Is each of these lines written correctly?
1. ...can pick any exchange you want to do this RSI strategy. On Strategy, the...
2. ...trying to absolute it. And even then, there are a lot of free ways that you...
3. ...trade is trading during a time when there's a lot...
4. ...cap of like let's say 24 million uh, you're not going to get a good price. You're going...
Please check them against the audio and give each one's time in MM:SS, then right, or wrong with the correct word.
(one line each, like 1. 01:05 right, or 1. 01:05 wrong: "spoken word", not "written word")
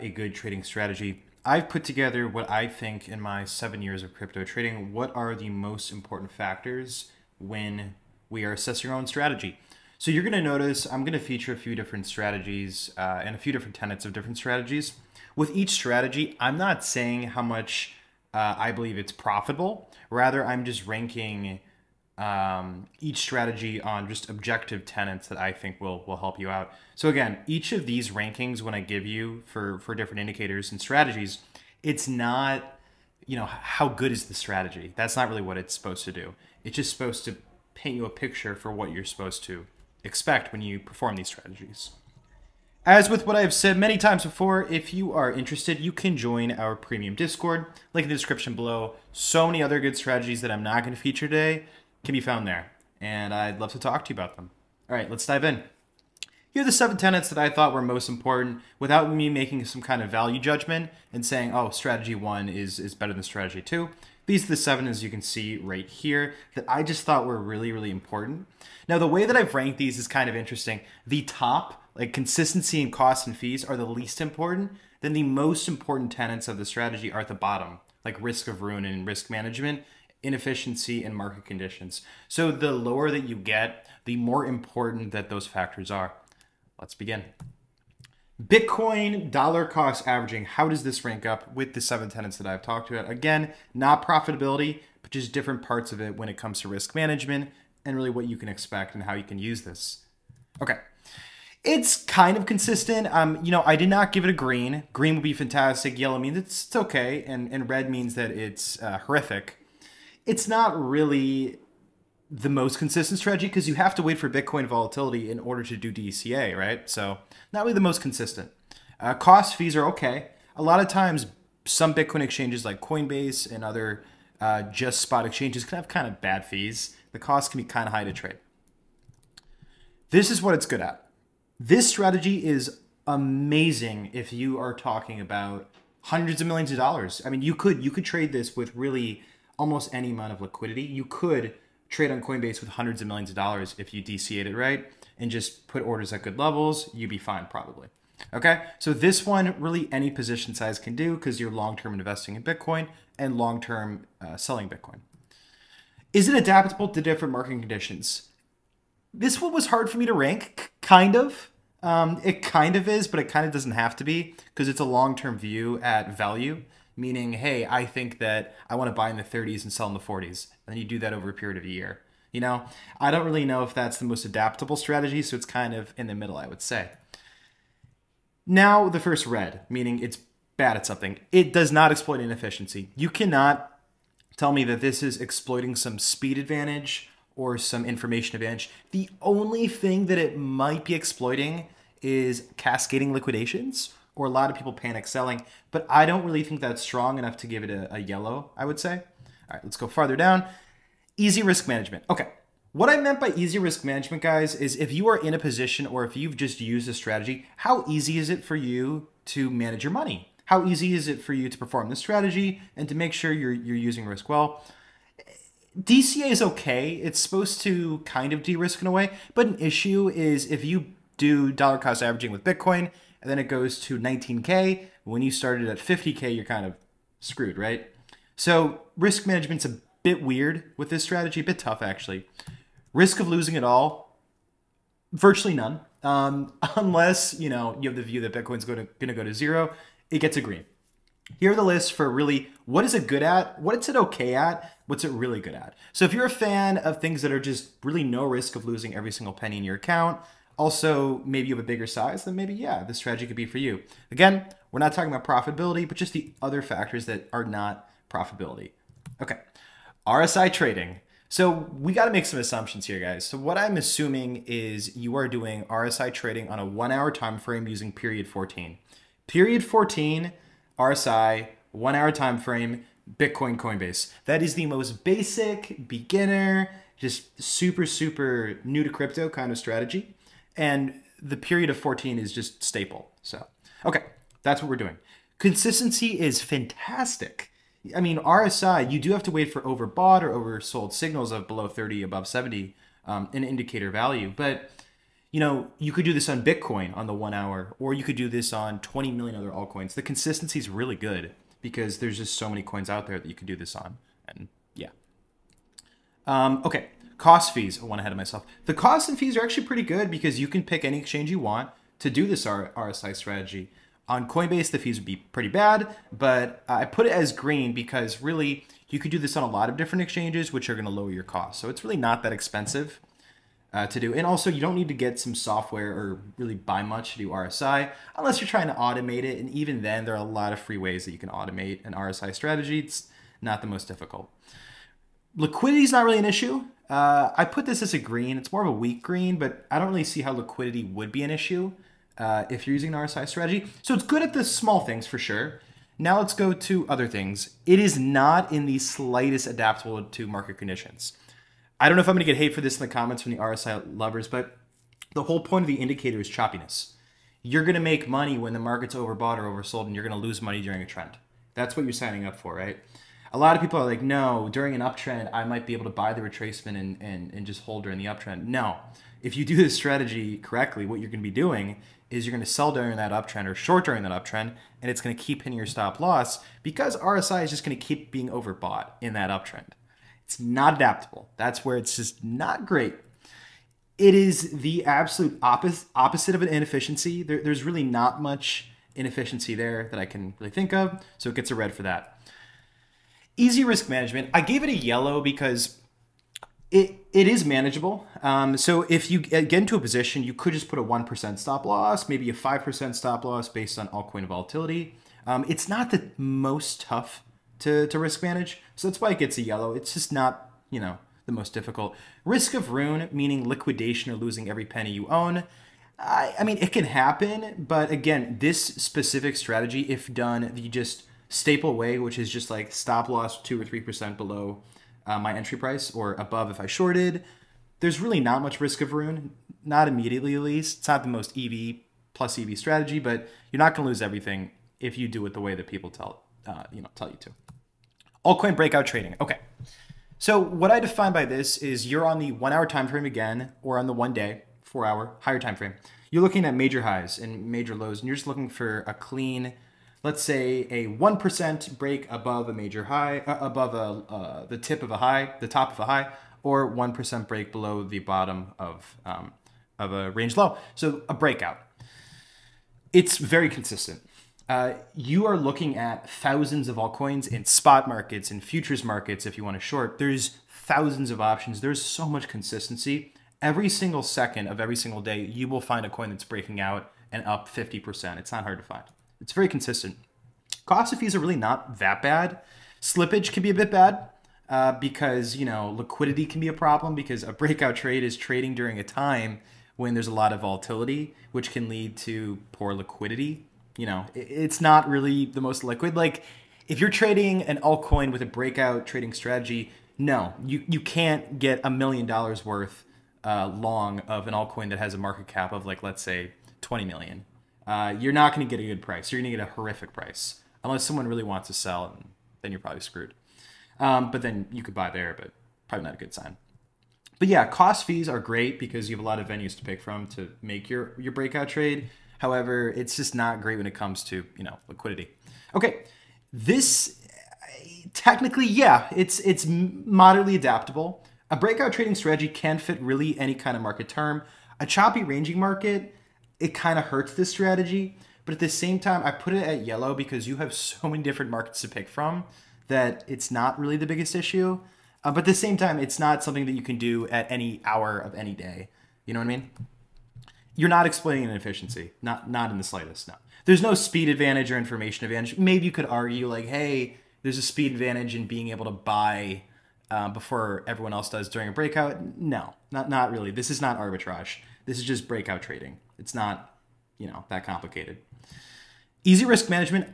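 1. 05:10 wrong: "Coinbase", not "Strategy"
2. 05:28 wrong: "automate", not "absolute"
3. 08:07 right
4. 08:25 wrong: "20", not "24".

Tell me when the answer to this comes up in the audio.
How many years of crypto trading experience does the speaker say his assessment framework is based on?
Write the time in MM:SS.
00:03.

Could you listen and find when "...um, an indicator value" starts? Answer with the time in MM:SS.
04:53.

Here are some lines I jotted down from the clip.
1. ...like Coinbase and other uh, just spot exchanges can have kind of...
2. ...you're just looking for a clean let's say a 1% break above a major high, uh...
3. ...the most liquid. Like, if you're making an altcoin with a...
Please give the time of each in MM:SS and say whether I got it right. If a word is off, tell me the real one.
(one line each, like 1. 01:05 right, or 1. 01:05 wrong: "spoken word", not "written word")
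1. 02:02 right
2. 07:28 right
3. 08:15 wrong: "trading", not "making".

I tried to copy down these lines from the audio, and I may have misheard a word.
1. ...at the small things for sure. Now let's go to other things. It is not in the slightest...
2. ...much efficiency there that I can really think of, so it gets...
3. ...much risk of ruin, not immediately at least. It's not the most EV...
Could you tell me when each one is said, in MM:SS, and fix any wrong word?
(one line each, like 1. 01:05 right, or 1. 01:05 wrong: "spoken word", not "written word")
1. 05:44 right
2. 06:28 wrong: "inefficiency", not "efficiency"
3. 07:08 right.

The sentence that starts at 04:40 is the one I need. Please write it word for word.
And the period of 14 is just staple.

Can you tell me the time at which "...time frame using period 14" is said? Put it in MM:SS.
04:27.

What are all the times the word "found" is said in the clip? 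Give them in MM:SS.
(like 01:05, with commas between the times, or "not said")
00:52.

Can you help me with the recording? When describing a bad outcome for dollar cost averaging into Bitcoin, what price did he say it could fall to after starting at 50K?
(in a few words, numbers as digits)
19K.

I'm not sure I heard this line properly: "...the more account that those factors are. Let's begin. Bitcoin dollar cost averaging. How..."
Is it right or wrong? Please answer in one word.
wrong.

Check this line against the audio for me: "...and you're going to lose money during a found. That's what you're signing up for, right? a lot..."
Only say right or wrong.
wrong.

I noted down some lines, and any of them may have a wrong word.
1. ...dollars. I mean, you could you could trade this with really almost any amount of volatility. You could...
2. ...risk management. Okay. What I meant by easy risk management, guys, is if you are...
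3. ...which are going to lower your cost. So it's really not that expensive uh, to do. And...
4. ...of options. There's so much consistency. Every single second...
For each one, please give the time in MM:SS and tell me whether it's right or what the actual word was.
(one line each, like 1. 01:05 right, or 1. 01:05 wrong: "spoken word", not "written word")
1. 02:16 wrong: "liquidity", not "volatility"
2. 03:21 right
3. 05:20 right
4. 07:51 right.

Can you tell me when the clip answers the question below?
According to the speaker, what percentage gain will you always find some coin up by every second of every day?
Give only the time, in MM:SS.
07:57.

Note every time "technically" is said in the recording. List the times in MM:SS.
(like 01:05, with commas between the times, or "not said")
08:47.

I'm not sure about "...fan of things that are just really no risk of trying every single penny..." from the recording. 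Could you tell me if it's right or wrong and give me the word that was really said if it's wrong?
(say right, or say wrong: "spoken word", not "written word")
wrong: "losing", not "trying".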